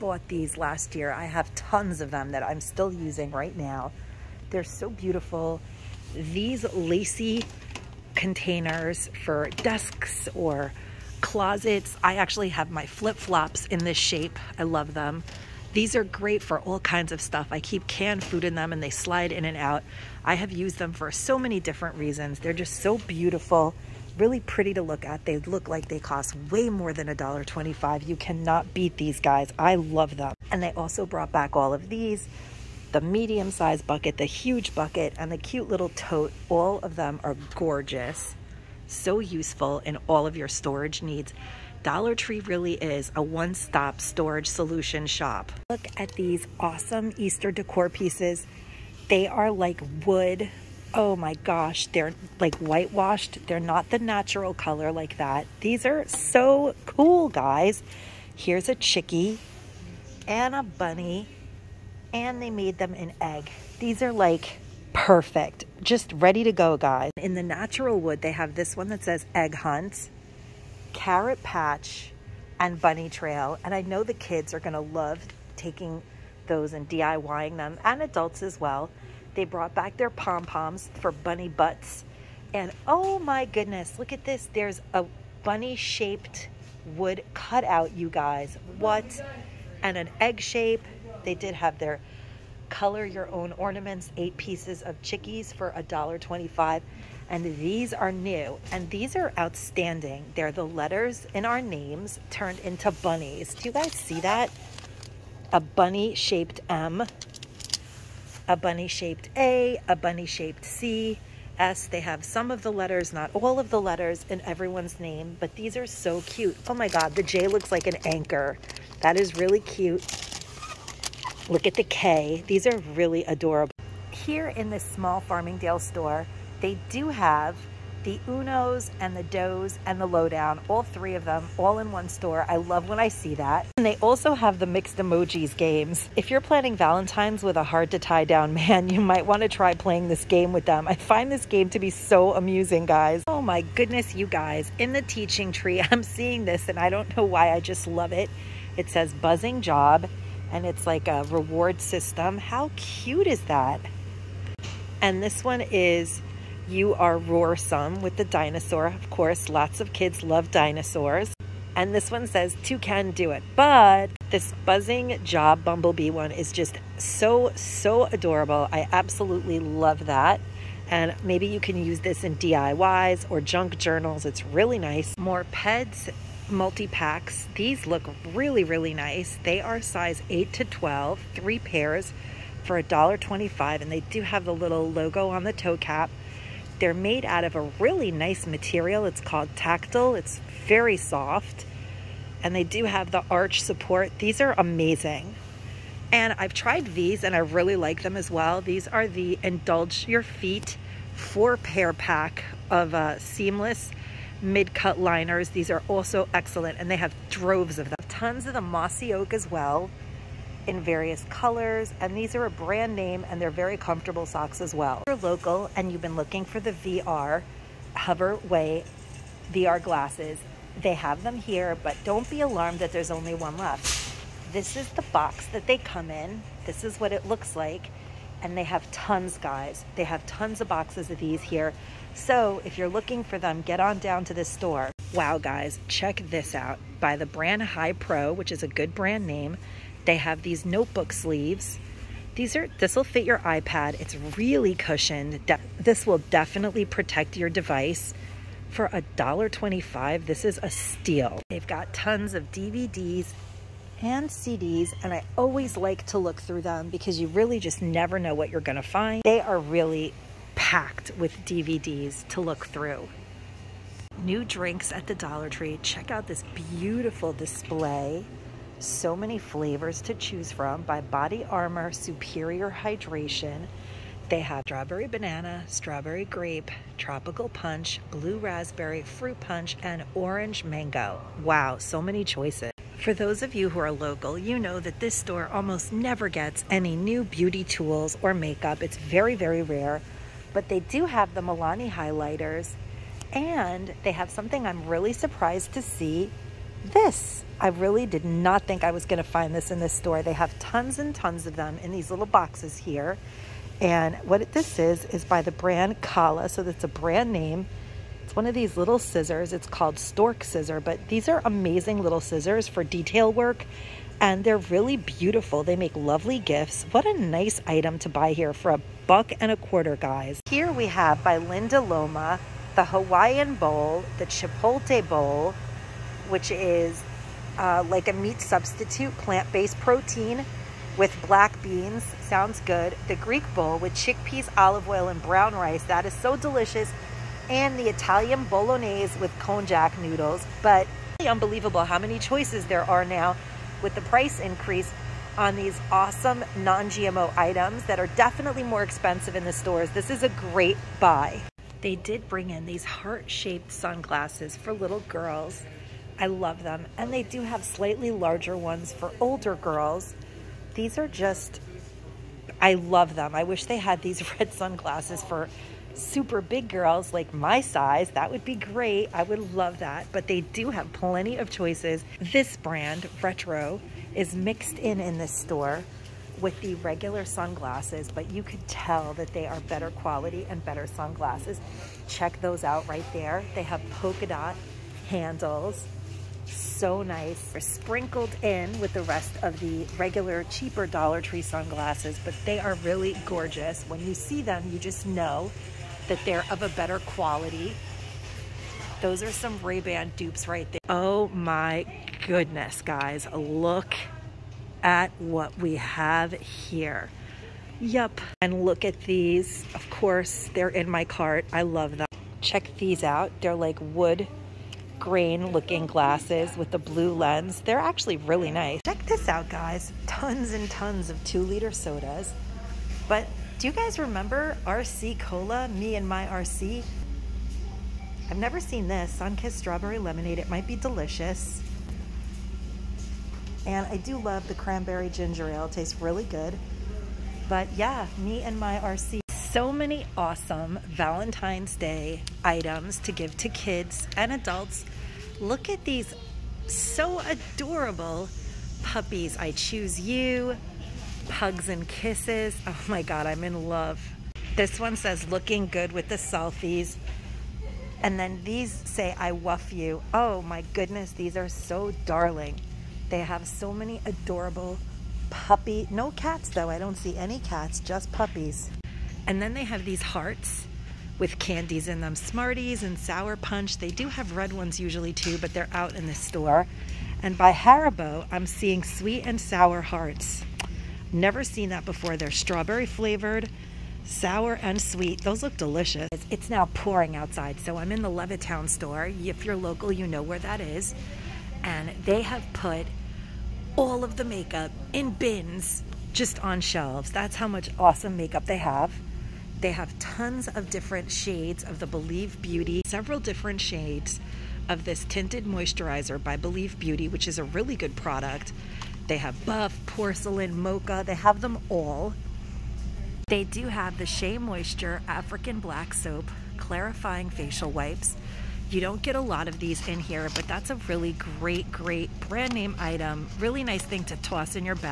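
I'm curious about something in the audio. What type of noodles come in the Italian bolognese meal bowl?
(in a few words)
konjac noodles.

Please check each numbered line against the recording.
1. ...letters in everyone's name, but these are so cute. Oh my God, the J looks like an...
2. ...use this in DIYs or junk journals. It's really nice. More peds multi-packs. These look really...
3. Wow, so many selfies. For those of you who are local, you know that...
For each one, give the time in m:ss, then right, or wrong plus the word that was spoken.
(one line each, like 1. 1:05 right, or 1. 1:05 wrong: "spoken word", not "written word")
1. 1:53 right
2. 2:51 right
3. 4:41 wrong: "choices", not "selfies".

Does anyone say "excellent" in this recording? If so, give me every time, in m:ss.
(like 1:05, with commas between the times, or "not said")
3:26.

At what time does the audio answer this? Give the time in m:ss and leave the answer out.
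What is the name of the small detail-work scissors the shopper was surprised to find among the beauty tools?
5:09.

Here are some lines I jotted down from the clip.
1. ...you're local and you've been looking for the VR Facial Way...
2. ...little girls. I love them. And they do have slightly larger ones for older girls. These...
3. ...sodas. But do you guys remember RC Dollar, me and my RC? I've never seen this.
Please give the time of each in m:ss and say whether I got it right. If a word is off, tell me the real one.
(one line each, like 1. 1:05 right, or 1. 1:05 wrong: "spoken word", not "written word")
1. 3:35 wrong: "Hover", not "Facial"
2. 5:54 right
3. 7:01 wrong: "Cola", not "Dollar".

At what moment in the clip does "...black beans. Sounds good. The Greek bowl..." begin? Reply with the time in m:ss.
5:31.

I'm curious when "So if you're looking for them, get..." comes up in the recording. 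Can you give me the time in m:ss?
3:52.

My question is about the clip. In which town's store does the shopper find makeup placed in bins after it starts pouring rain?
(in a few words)
Levittown.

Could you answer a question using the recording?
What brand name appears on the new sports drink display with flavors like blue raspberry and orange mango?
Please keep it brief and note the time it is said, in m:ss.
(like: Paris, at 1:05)
Body Armor, at 4:31.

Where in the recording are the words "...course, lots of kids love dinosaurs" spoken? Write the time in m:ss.
2:39.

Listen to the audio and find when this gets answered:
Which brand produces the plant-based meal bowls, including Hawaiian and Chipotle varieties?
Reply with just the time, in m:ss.
5:21.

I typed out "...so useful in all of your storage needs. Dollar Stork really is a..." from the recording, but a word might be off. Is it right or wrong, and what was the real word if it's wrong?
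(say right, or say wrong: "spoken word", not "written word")
wrong: "Tree", not "Stork".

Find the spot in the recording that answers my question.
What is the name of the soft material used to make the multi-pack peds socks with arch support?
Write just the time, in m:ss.
3:09.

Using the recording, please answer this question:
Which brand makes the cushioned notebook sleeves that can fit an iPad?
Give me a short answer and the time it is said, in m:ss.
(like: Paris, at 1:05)
High Pro, at 3:57.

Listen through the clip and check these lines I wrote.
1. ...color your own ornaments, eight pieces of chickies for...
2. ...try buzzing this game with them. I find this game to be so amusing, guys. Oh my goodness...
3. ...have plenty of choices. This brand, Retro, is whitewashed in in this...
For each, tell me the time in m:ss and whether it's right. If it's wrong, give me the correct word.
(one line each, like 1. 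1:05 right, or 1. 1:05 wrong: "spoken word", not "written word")
1. 1:32 right
2. 2:19 wrong: "playing", not "buzzing"
3. 6:10 wrong: "mixed", not "whitewashed".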